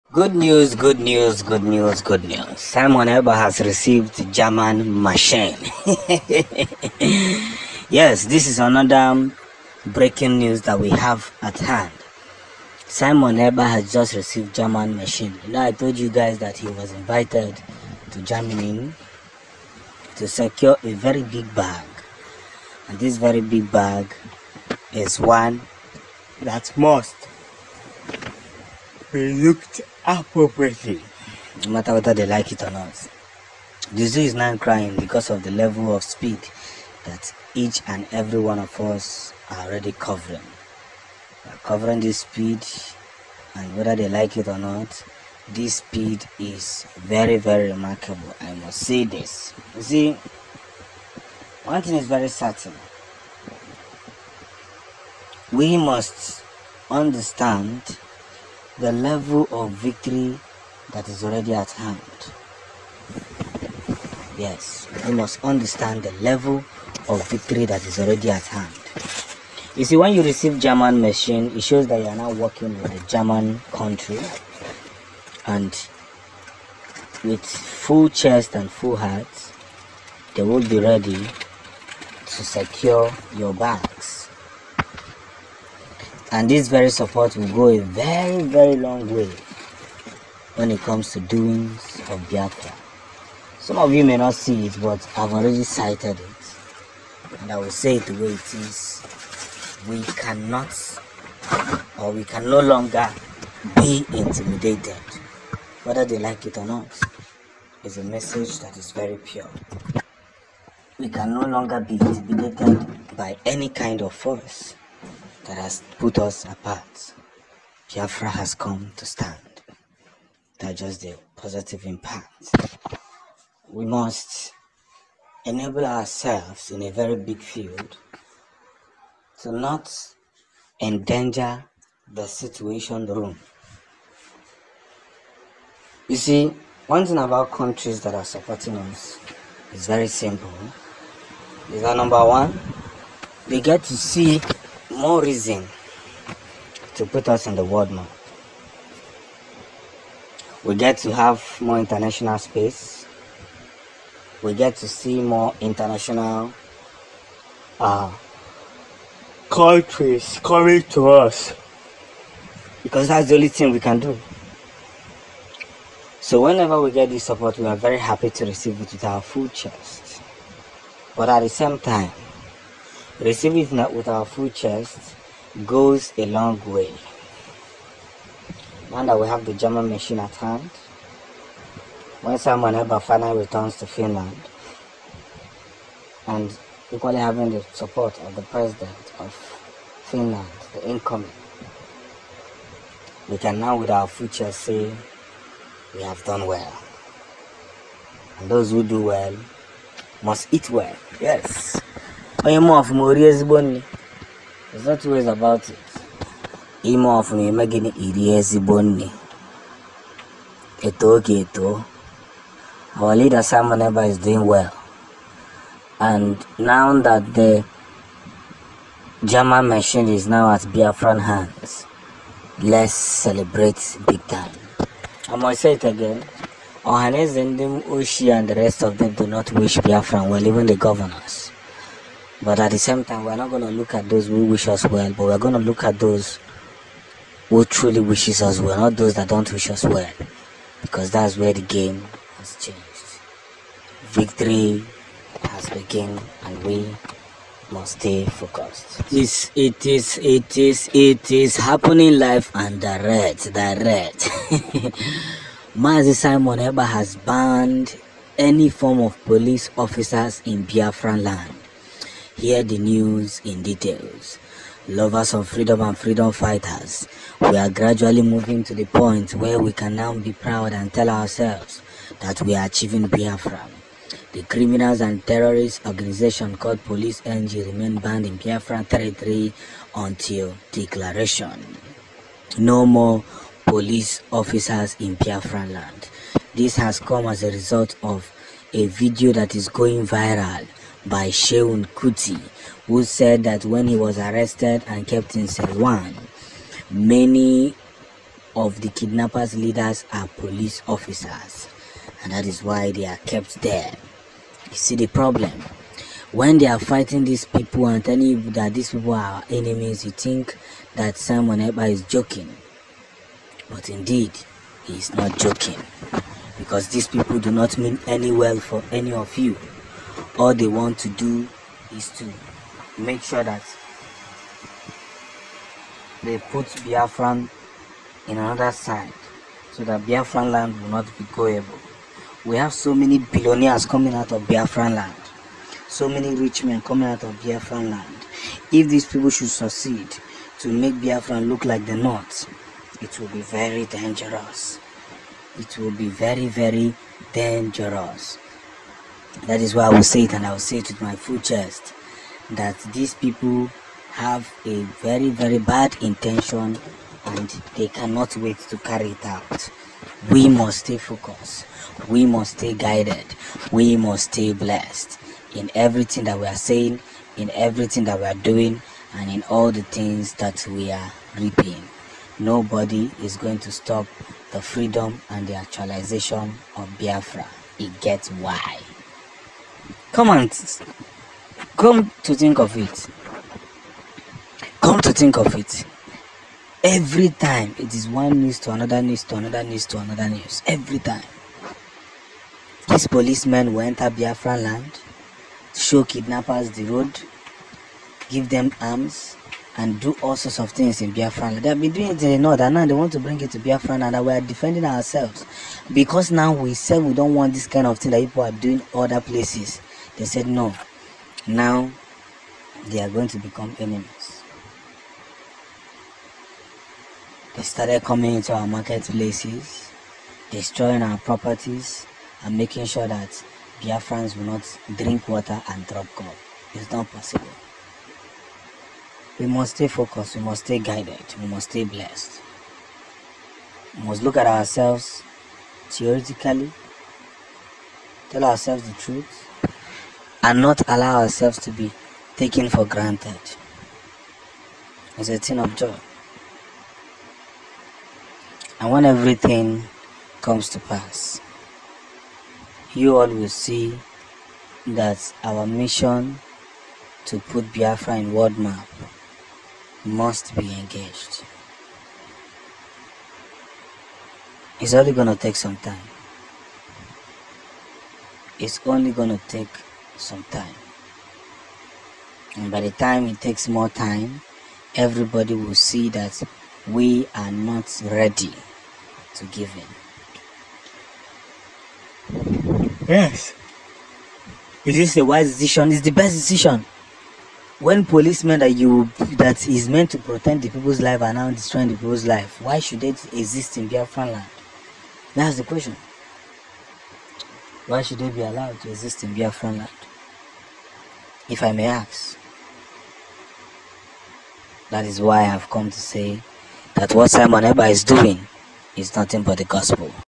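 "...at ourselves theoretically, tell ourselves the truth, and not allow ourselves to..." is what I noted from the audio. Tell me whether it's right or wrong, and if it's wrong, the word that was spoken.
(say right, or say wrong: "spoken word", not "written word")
right.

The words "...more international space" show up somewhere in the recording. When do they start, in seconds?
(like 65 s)
151 s.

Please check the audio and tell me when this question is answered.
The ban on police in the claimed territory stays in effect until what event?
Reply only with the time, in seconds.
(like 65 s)
280 s.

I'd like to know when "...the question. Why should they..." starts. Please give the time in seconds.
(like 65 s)
495 s.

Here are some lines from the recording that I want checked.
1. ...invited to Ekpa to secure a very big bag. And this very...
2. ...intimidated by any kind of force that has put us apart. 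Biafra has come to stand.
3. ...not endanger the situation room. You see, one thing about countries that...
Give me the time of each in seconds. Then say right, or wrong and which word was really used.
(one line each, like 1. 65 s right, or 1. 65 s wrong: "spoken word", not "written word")
1. 16 s wrong: "Germany", not "Ekpa"
2. 111 s right
3. 129 s right.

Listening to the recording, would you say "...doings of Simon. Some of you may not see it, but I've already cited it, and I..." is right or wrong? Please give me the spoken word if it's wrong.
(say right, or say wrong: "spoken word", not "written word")
wrong: "Biafra", not "Simon".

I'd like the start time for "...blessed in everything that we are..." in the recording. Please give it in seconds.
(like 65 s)
364 s.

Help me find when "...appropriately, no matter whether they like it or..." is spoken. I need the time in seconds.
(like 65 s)
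30 s.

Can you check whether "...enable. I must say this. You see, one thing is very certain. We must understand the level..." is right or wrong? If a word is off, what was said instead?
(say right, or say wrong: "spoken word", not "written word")
wrong: "remarkable", not "enable".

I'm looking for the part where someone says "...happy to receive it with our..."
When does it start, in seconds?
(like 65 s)
167 s.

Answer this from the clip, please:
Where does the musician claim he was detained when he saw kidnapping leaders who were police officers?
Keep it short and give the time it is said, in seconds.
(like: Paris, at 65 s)
Selwan, at 295 s.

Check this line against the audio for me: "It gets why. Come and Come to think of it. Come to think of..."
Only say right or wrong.
right.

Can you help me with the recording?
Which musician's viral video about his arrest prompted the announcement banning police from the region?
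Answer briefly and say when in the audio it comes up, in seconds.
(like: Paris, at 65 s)
Seun Kuti, at 291 s.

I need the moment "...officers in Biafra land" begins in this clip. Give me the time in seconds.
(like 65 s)
284 s.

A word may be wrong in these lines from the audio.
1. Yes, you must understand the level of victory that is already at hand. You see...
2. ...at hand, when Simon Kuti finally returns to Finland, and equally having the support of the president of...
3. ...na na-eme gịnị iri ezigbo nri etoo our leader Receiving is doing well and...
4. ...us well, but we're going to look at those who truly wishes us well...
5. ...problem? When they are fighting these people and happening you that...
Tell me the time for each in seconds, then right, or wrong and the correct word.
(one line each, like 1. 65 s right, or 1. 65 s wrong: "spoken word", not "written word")
1. 64 s right
2. 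180 s wrong: "Ekpa", not "Kuti"
3. 207 s wrong: "Simon", not "Receiving"
4. 234 s right
5. 305 s wrong: "telling", not "happening".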